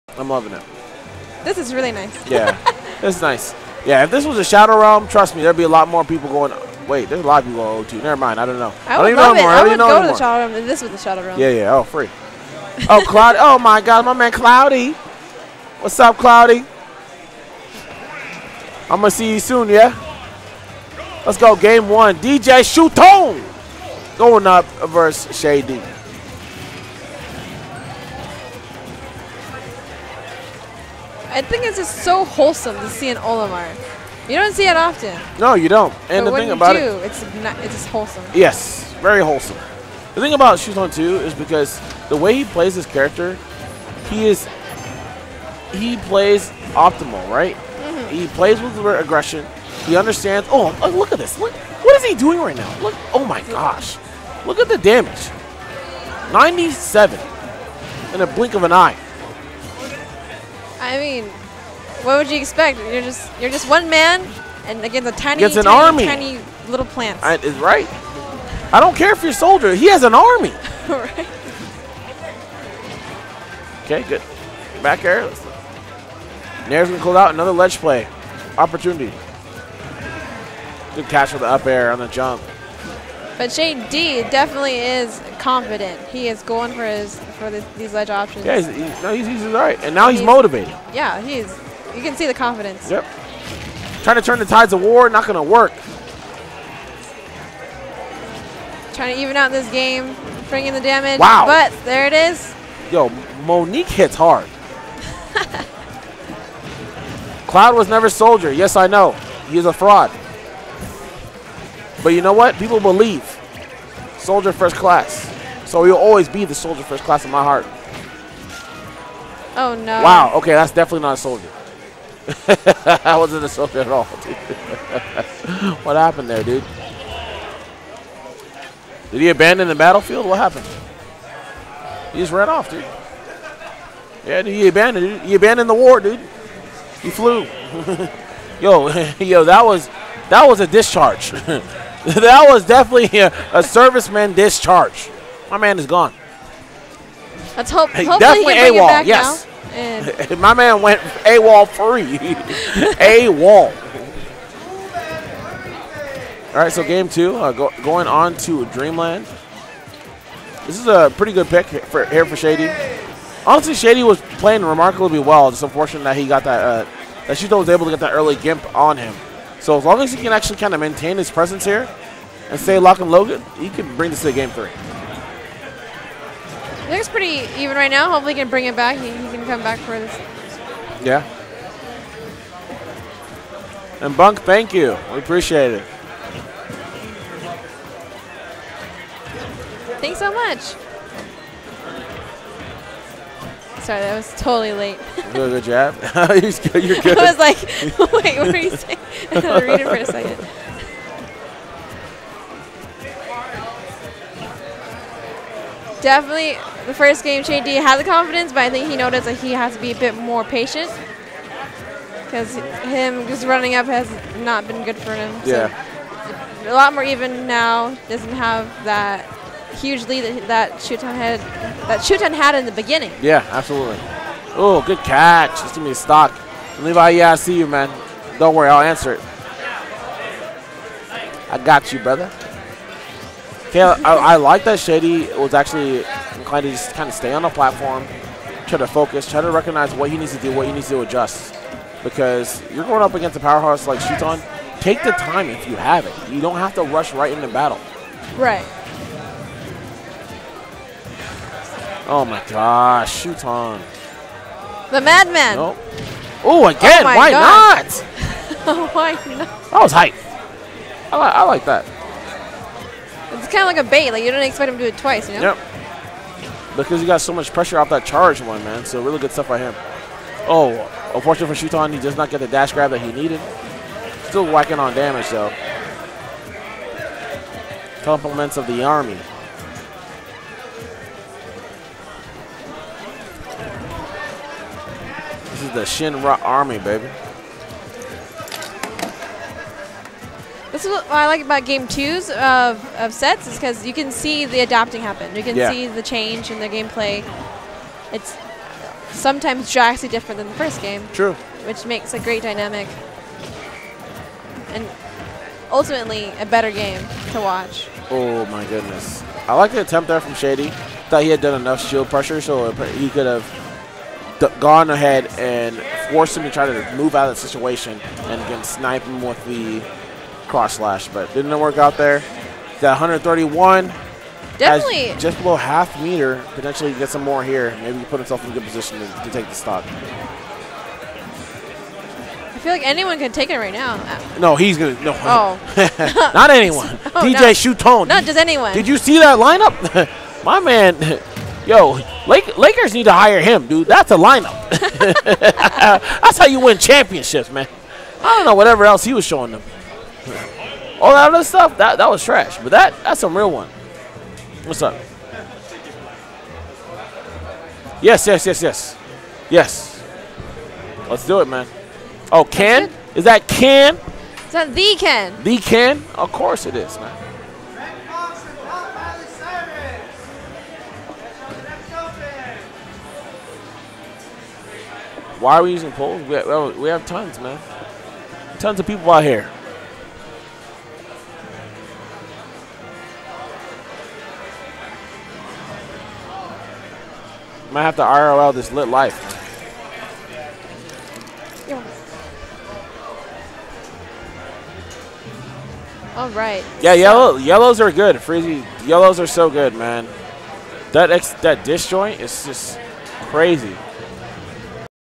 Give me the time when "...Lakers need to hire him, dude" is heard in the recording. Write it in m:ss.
5:42.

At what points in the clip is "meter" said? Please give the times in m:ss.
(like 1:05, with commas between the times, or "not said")
5:26.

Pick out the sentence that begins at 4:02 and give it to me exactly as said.
Because you're going up against a powerhouse like Shuton.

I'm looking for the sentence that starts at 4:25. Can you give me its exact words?
Yep because he got so much pressure off that charge one, man.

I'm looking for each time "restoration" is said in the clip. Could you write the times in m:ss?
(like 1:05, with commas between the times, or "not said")
not said.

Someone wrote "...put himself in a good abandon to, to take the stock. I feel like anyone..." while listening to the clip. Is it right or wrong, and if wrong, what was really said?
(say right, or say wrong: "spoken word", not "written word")
wrong: "position", not "abandon".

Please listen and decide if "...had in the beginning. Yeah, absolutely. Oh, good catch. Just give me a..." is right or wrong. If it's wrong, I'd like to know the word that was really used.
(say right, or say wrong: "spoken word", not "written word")
right.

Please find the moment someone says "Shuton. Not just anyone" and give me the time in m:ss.
5:37.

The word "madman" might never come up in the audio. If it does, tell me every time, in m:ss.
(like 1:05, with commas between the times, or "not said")
4:14.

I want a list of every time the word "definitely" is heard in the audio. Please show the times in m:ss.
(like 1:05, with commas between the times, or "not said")
1:24, 2:00, 2:22, 2:28, 3:26, 5:24.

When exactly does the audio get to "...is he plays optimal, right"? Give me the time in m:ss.
0:44.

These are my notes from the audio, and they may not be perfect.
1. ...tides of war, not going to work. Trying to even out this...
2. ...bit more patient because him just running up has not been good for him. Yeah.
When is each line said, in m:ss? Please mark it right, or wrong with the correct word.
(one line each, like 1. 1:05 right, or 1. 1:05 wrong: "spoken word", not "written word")
1. 1:34 right
2. 3:29 right.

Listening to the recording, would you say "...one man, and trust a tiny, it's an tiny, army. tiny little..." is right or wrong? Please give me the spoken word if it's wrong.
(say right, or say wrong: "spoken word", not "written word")
wrong: "against", not "trust".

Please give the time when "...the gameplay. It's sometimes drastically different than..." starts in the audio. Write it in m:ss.
4:56.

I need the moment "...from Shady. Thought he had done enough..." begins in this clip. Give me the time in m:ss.
5:10.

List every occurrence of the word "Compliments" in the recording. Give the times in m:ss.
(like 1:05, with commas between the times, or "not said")
4:38.